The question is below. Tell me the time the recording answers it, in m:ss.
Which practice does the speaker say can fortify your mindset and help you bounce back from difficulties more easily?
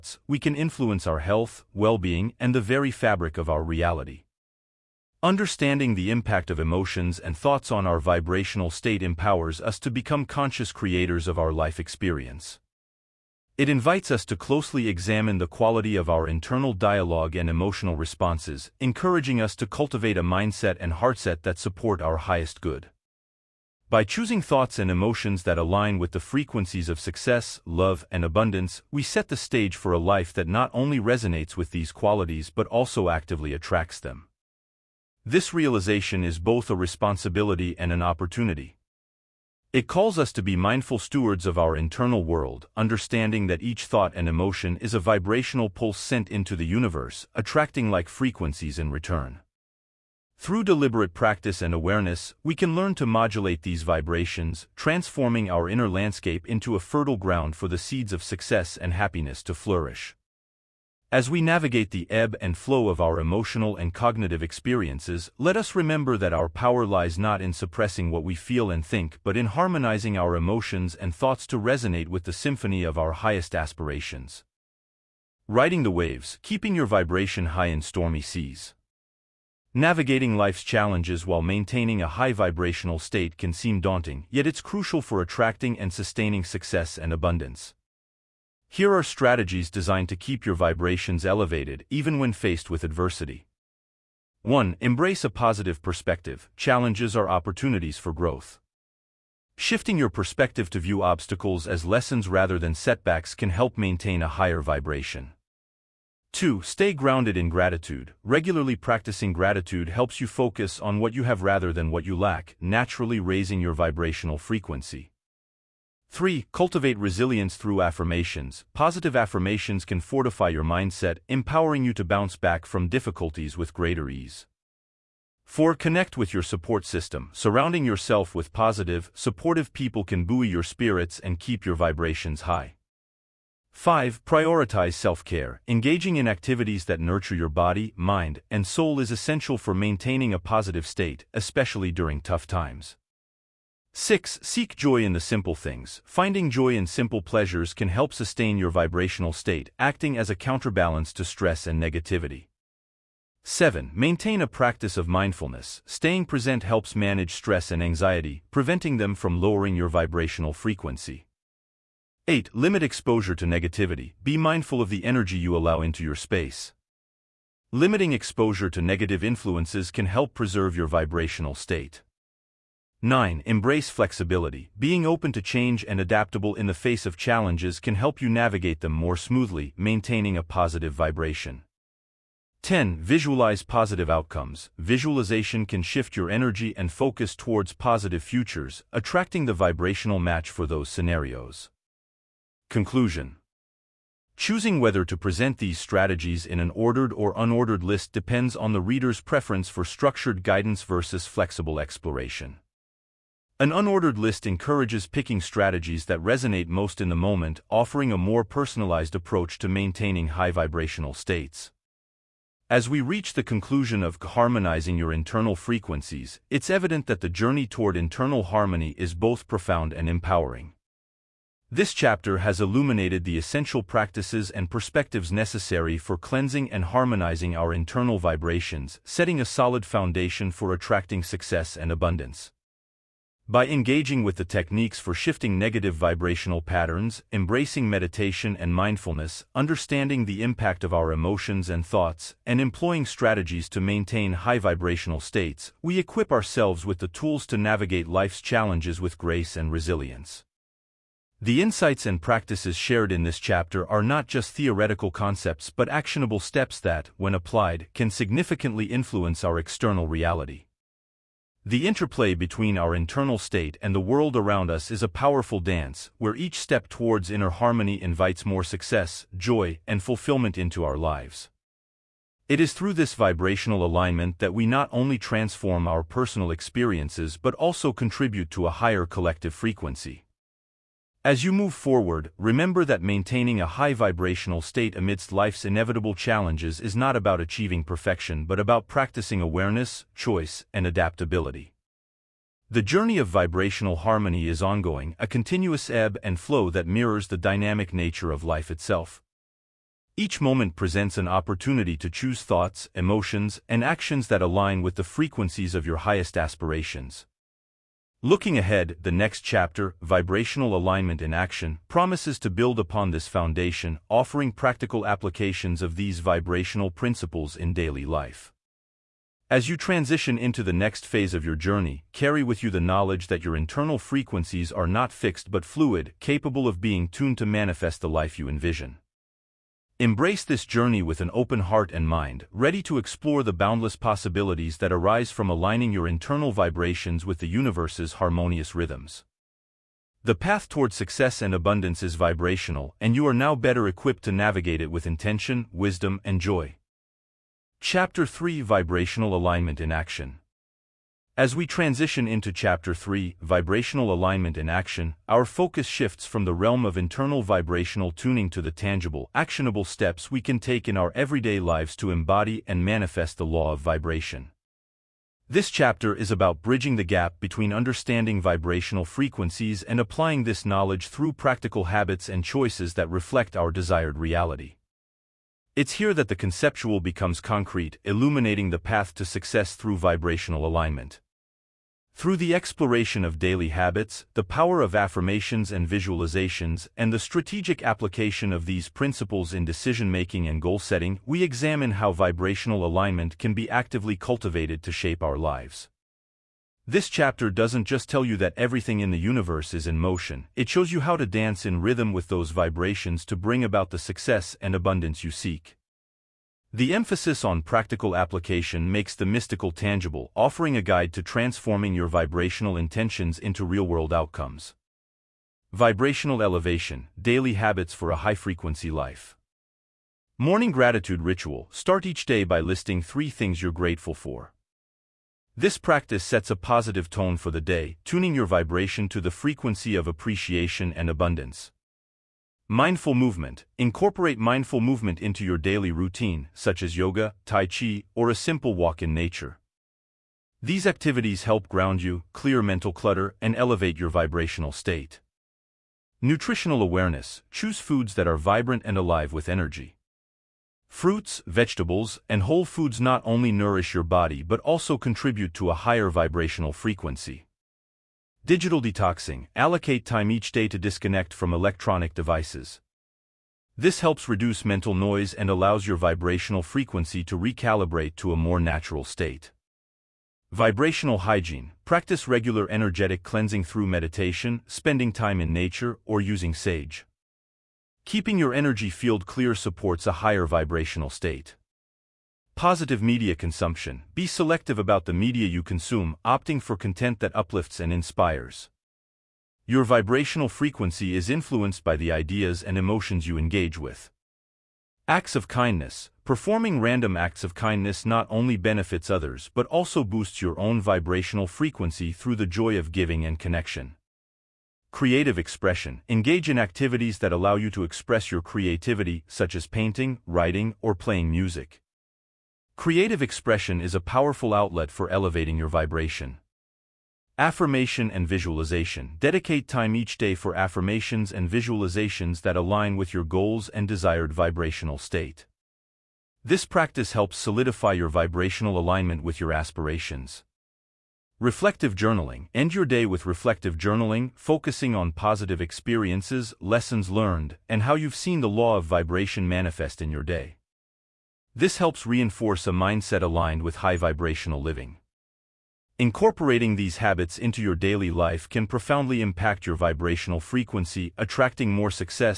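1:58.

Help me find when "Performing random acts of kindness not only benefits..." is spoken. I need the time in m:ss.
8:16.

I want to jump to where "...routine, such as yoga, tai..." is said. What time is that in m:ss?
7:15.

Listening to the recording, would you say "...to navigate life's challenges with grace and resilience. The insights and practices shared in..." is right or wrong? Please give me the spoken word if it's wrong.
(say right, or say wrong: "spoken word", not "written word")
right.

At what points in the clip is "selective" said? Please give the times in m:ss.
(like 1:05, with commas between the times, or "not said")
8:04.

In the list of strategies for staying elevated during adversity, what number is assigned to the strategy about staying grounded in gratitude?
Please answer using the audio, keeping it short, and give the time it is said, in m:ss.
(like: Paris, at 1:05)
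2, at 1:46.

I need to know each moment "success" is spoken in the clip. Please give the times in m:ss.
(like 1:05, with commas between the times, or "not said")
0:26, 0:58, 1:26, 3:51, 4:28, 5:40, 6:19, 6:43.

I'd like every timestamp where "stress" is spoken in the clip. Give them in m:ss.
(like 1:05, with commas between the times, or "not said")
2:31, 2:37.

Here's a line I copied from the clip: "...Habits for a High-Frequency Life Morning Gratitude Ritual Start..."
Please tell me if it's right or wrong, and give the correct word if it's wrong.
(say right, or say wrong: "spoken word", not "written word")
right.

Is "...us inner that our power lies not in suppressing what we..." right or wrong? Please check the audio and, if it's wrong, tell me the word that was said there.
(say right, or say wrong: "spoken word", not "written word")
wrong: "remember", not "inner".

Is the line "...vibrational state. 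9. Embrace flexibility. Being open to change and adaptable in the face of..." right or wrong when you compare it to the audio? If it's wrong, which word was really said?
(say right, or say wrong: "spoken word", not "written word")
right.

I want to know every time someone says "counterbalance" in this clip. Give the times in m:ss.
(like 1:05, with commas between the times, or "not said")
2:30.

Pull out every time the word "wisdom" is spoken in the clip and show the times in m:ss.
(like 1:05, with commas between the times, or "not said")
5:45.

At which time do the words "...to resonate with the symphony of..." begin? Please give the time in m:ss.
1:11.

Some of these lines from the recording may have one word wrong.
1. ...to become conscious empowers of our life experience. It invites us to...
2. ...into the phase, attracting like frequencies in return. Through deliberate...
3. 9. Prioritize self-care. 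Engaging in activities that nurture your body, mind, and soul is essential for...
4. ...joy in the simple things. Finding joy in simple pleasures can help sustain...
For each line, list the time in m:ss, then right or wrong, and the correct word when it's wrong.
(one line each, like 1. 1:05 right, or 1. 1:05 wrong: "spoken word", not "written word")
1. 0:09 wrong: "creators", not "empowers"
2. 0:46 wrong: "universe", not "phase"
3. 2:13 wrong: "5", not "9"
4. 2:24 right.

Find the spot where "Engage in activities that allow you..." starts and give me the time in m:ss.
8:26.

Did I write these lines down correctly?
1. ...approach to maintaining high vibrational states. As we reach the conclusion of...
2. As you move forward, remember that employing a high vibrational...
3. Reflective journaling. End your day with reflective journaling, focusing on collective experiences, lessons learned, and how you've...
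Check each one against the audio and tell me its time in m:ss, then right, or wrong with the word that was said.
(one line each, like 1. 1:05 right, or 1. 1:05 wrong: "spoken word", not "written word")
1. 3:29 right
2. 4:41 wrong: "maintaining", not "employing"
3. 8:51 wrong: "positive", not "collective".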